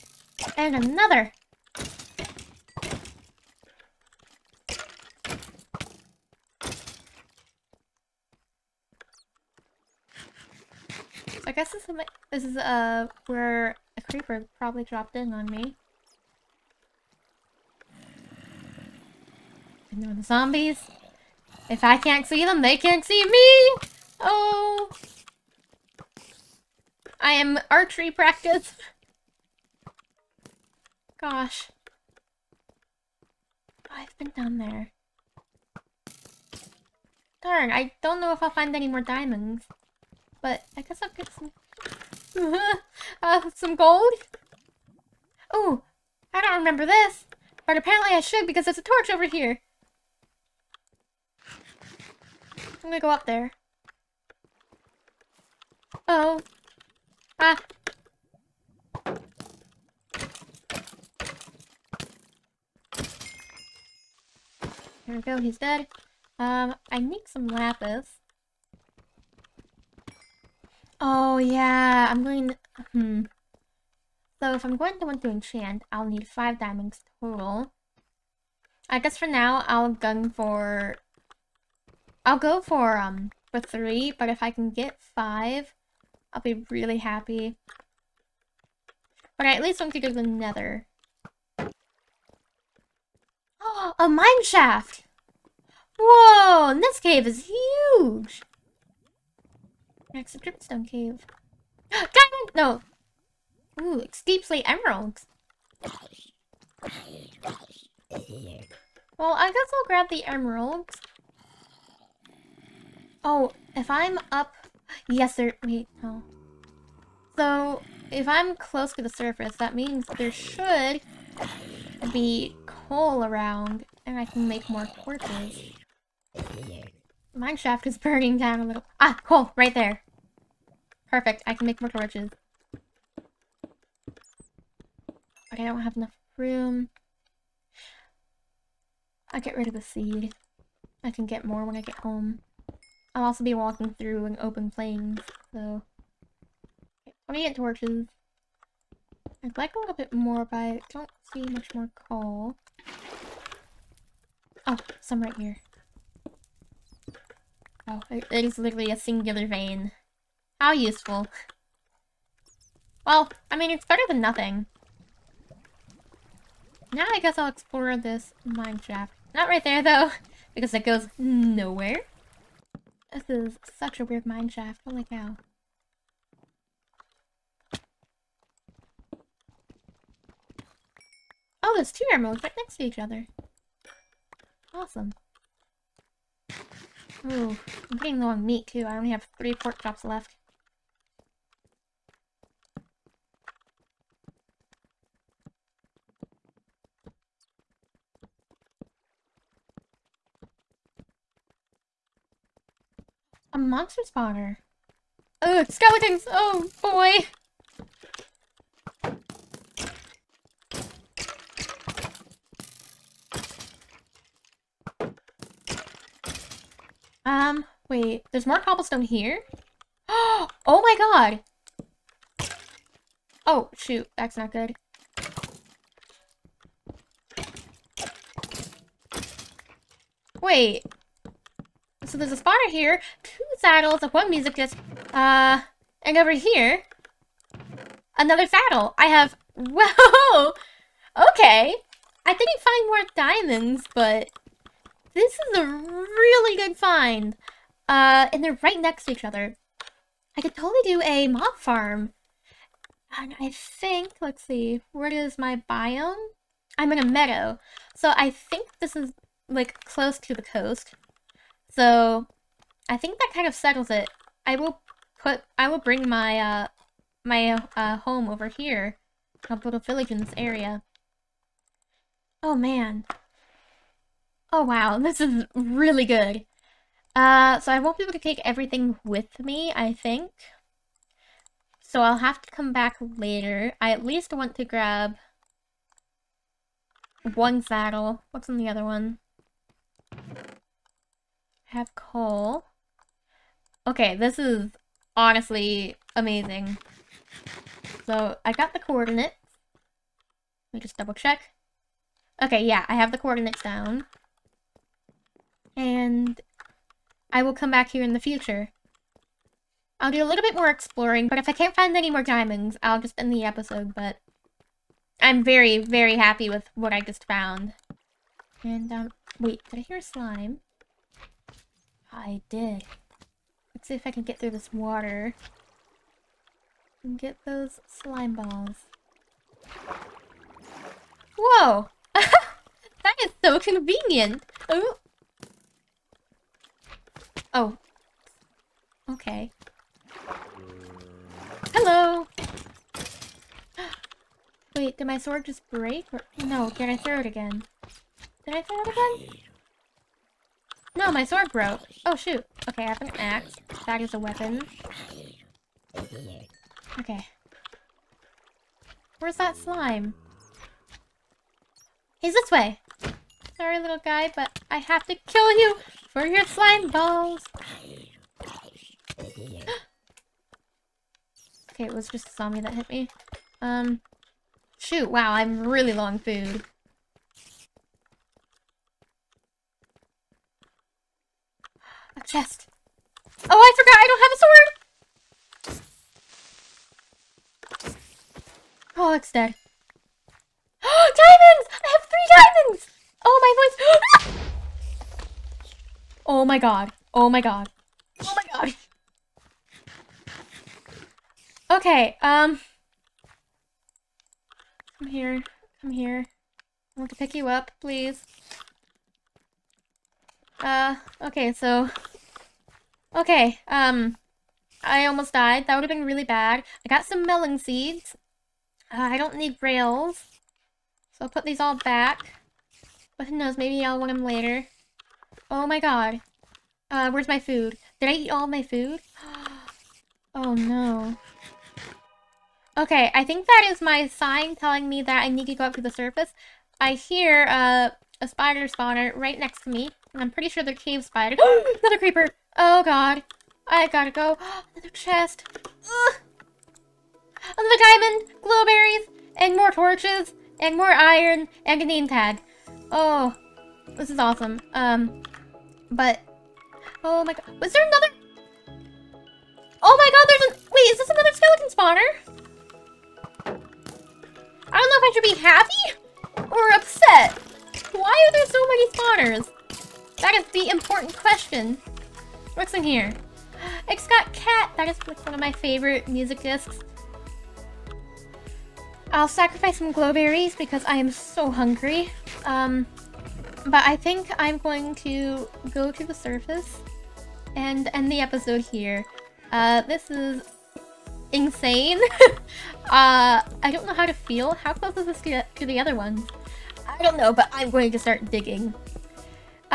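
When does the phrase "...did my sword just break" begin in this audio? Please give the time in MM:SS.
05:44.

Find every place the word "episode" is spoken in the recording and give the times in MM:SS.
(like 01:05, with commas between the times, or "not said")
05:13, 08:08.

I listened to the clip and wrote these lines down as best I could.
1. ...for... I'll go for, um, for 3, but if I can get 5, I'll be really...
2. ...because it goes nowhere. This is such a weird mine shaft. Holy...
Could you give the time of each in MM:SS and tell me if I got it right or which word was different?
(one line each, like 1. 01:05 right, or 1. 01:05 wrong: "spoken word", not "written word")
1. 01:20 right
2. 02:50 right.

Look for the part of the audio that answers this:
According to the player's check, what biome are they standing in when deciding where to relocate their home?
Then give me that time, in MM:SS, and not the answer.
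04:16.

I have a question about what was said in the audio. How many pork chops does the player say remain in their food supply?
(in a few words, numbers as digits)
3.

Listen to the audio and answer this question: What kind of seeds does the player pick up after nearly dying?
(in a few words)
melon seeds.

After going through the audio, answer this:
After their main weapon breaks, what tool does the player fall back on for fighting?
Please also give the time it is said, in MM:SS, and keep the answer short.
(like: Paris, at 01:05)
an axe, at 05:53.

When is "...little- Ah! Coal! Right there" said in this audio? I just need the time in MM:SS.
02:08.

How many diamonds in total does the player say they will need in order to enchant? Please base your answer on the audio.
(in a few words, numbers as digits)
5.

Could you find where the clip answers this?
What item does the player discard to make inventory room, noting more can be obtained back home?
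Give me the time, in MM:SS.
02:19.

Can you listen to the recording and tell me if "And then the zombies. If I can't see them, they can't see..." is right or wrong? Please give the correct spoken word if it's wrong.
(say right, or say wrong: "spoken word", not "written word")
right.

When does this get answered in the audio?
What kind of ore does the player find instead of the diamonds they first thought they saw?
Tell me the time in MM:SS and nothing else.
01:44.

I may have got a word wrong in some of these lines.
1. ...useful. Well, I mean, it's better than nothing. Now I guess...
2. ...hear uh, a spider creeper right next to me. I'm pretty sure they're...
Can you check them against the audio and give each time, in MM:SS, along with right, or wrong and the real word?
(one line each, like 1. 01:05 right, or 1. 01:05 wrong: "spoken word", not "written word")
1. 02:40 right
2. 07:16 wrong: "spawner", not "creeper".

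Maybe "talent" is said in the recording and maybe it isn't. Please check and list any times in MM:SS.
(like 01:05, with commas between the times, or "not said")
not said.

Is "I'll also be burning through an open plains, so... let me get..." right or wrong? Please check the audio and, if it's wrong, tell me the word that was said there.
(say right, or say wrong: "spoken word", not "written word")
wrong: "walking", not "burning".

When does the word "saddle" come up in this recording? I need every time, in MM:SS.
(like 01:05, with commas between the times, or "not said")
03:53, 03:58, 04:47.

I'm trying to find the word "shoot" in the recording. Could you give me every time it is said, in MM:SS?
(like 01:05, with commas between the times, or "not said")
03:43, 05:52, 06:14.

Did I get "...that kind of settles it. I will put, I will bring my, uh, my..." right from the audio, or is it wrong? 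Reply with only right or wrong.
right.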